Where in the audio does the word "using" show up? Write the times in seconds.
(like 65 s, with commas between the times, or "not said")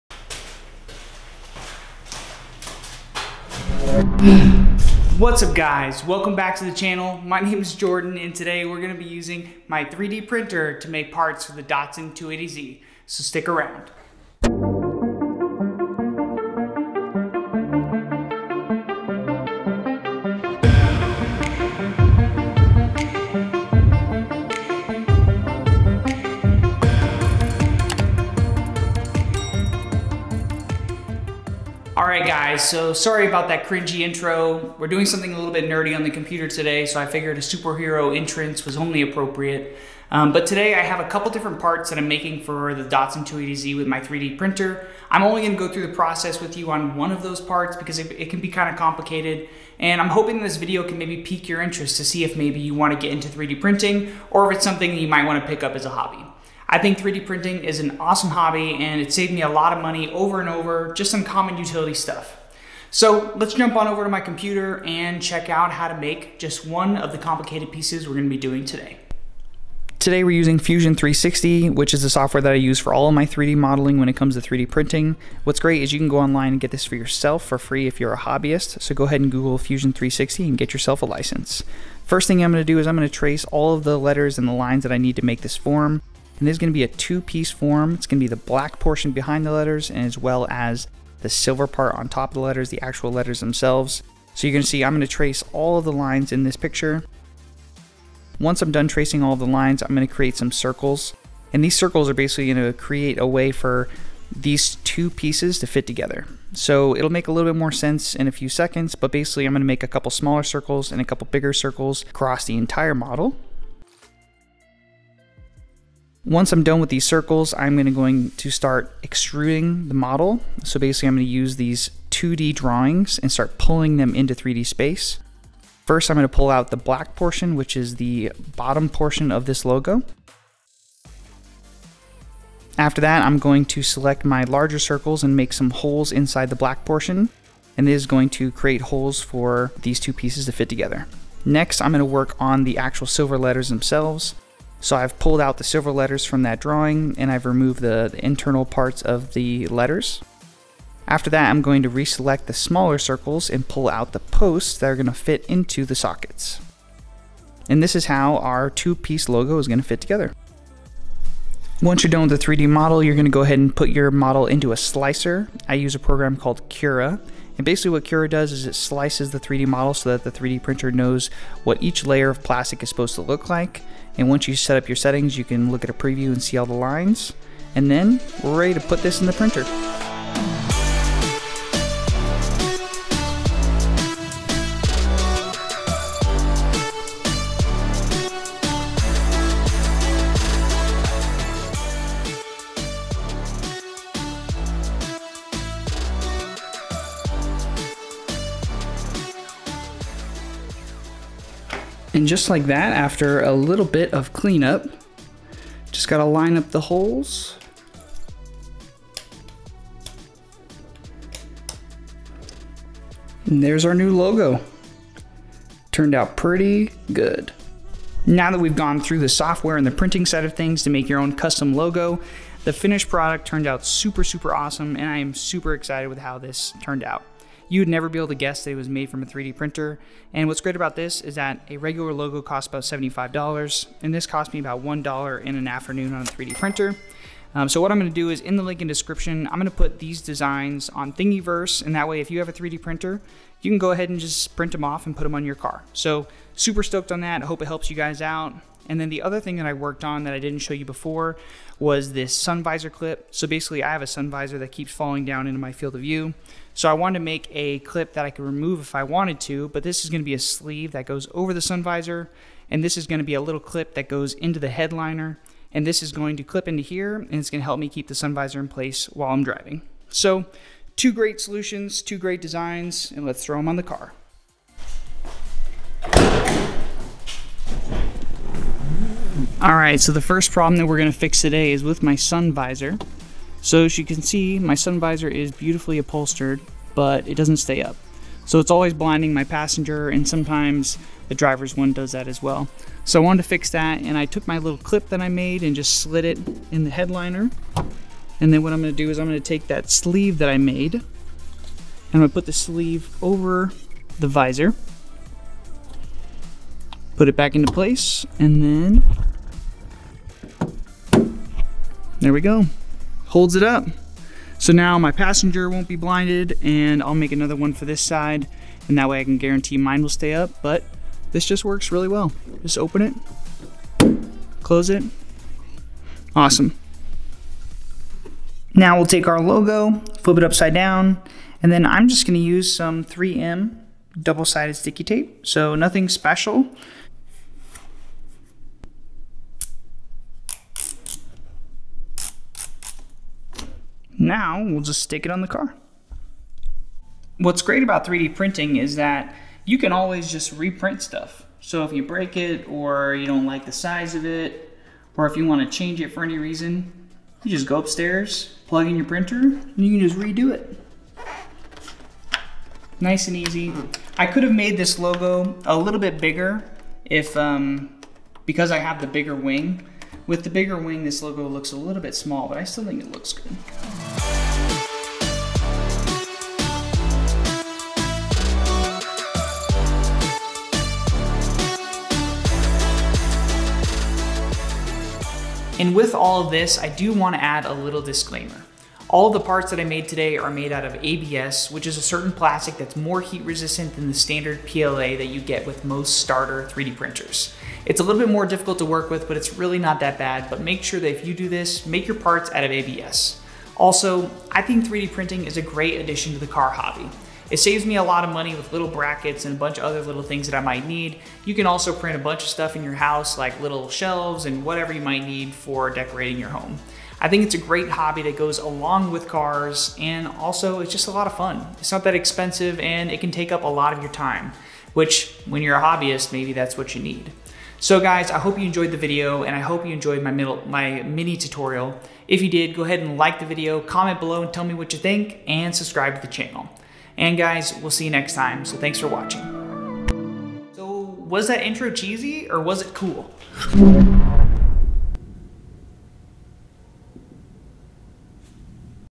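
9 s, 70 s.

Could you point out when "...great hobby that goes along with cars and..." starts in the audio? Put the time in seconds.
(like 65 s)
417 s.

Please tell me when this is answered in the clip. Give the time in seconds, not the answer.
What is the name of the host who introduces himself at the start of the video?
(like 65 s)
7 s.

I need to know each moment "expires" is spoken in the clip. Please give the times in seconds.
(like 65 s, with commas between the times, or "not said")
not said.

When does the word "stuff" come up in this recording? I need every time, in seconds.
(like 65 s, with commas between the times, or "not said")
61 s, 351 s, 412 s.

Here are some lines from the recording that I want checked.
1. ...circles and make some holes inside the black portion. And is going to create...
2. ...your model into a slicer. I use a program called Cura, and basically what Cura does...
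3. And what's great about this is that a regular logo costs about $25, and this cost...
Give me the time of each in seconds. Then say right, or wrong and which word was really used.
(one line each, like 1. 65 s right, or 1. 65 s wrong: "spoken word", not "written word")
1. 134 s right
2. 163 s right
3. 230 s wrong: "75", not "25".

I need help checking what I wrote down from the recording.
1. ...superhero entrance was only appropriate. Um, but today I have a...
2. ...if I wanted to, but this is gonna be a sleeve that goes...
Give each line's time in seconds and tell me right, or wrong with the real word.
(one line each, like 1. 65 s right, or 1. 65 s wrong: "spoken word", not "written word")
1. 37 s right
2. 258 s right.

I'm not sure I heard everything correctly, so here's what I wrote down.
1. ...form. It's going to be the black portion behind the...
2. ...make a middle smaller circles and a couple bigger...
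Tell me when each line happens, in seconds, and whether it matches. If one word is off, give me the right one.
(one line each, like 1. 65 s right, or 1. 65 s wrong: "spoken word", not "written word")
1. 87 s right
2. 109 s wrong: "couple", not "middle".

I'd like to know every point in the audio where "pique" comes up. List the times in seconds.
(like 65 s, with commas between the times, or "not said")
51 s.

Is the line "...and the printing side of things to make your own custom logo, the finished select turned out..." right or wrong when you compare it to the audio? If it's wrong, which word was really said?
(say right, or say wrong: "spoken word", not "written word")
wrong: "product", not "select".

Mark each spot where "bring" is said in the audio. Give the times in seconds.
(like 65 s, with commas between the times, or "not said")
not said.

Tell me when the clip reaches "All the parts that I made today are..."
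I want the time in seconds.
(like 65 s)
389 s.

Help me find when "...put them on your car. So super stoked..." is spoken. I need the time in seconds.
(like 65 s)
245 s.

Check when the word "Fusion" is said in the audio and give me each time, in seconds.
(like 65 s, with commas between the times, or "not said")
70 s, 79 s.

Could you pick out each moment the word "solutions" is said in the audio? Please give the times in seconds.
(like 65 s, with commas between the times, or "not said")
271 s.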